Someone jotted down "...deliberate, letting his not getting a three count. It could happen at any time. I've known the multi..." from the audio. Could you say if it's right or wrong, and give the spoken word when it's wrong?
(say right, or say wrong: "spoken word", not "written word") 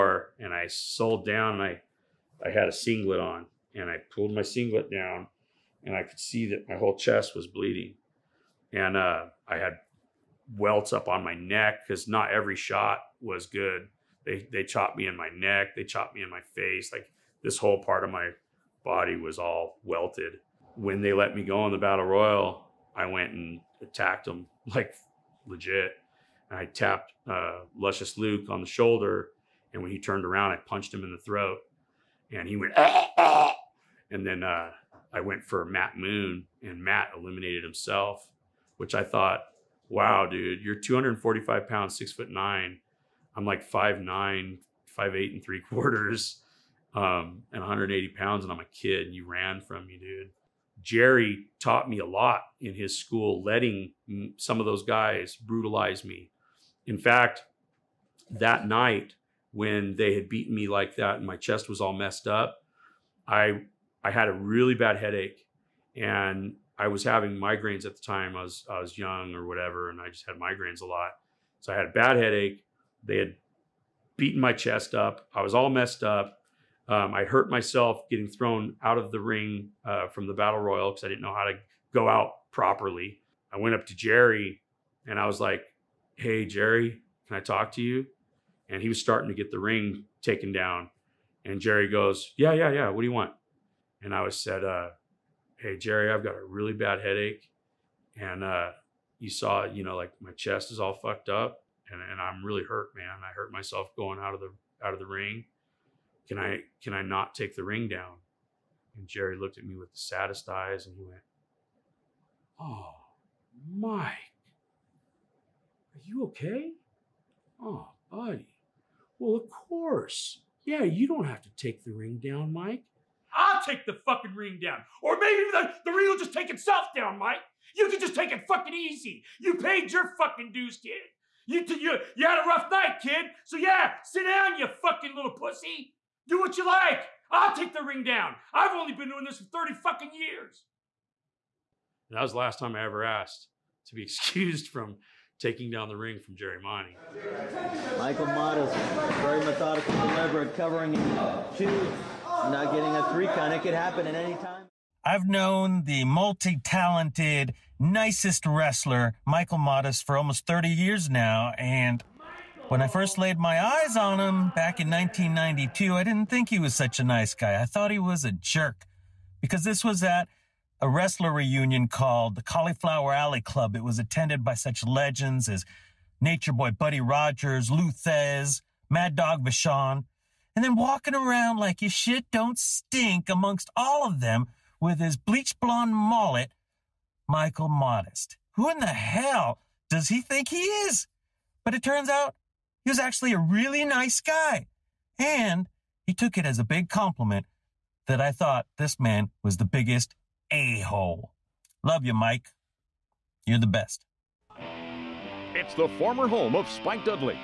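wrong: "covering", not "letting".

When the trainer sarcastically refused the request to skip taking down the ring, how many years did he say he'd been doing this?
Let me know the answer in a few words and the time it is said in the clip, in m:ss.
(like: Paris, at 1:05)
30, at 2:19.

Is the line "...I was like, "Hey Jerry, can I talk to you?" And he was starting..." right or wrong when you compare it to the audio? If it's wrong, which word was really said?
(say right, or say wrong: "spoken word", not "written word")
right.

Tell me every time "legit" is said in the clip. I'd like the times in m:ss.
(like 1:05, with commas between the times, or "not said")
0:25.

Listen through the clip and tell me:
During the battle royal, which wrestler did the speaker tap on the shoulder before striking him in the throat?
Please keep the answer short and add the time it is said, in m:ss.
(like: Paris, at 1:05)
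Luscious Luke, at 0:27.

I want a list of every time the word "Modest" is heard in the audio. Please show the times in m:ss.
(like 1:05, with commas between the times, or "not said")
2:28, 2:39, 3:07.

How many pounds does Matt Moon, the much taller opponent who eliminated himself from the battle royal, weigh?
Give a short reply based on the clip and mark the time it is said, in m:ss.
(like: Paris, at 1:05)
245, at 0:40.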